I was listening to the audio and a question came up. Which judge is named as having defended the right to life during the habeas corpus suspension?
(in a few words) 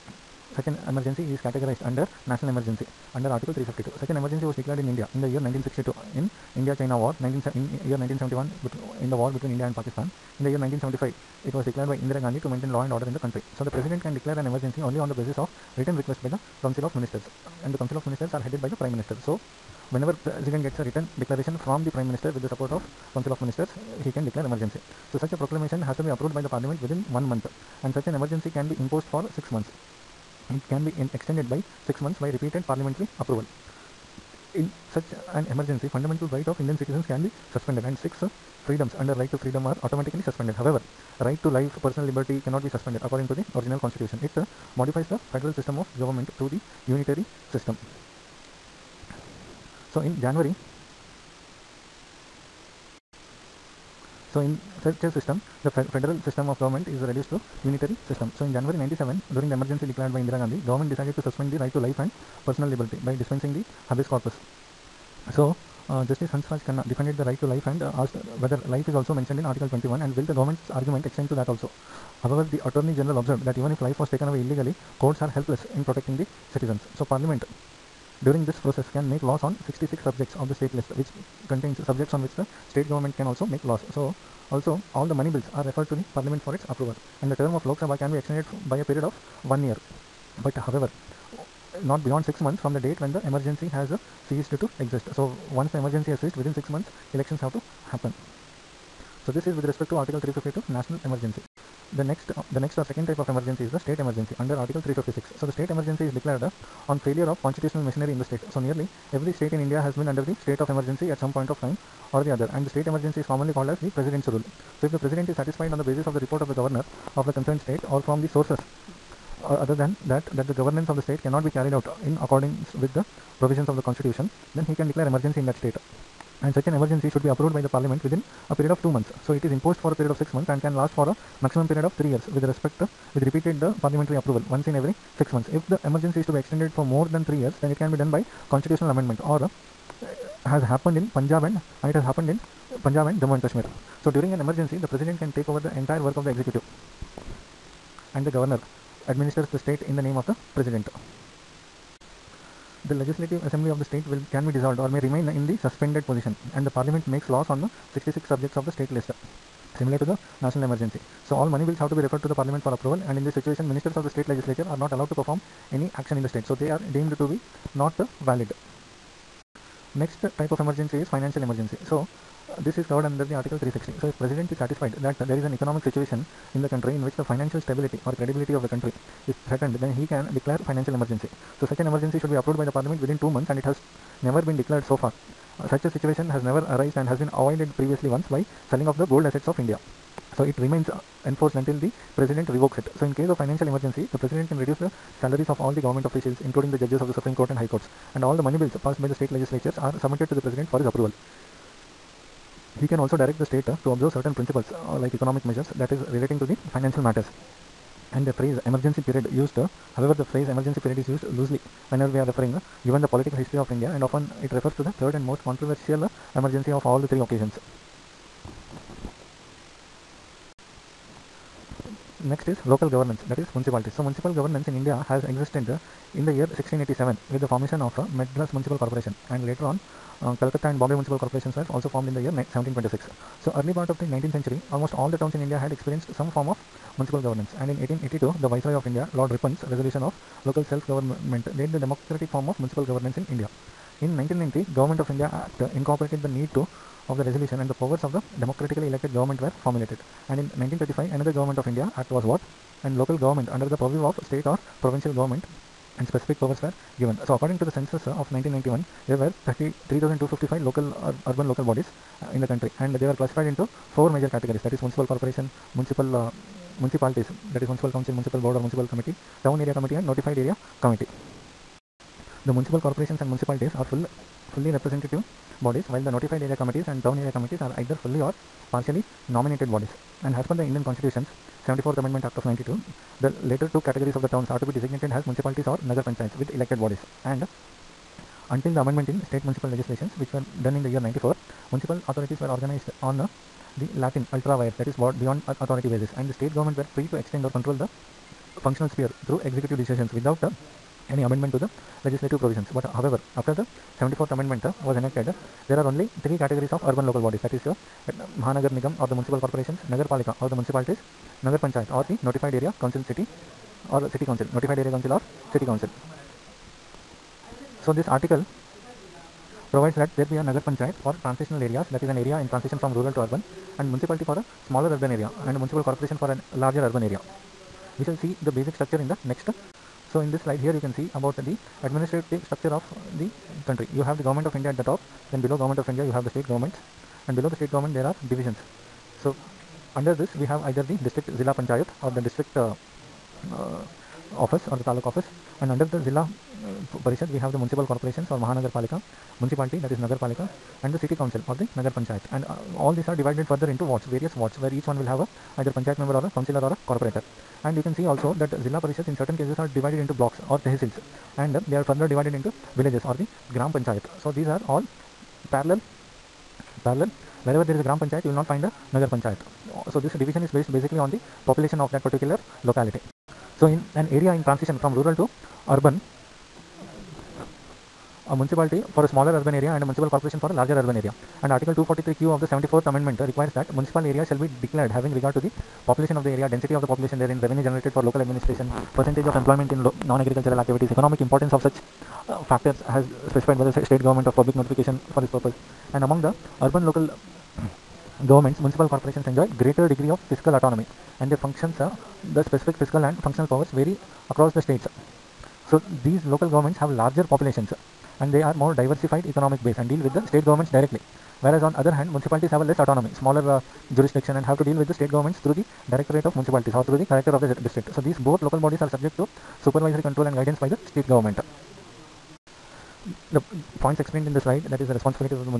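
Hansraj Khanna.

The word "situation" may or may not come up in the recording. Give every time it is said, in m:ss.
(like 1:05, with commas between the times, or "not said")
2:43, 2:55, 3:05.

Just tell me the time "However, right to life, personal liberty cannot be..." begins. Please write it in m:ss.
0:40.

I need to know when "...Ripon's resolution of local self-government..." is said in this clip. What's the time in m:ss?
3:59.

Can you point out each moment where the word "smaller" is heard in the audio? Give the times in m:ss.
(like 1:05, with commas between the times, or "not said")
5:24, 6:19, 6:53.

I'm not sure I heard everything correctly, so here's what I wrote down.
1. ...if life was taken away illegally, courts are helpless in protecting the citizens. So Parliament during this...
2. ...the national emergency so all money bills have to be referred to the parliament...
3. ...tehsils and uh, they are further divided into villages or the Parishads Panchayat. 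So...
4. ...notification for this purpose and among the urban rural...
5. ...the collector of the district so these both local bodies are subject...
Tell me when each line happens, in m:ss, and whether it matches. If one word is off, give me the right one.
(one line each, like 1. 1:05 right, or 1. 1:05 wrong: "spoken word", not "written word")
1. 1:13 right
2. 2:40 right
3. 6:00 wrong: "Gram", not "Parishads"
4. 6:34 wrong: "local", not "rural"
5. 6:57 right.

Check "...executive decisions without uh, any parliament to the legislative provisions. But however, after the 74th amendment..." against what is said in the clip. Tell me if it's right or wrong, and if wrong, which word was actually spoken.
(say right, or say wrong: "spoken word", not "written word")
wrong: "amendment", not "parliament".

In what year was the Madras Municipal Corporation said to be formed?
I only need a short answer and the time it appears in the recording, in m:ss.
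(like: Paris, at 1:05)
1687, at 3:46.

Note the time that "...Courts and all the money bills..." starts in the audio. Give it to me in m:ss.
3:17.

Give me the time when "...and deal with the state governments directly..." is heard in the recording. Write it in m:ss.
6:49.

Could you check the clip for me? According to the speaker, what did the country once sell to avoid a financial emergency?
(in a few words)
Gold assets.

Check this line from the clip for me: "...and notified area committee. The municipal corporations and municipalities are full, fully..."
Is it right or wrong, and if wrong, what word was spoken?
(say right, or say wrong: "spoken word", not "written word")
right.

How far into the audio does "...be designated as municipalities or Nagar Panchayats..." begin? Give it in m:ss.
4:44.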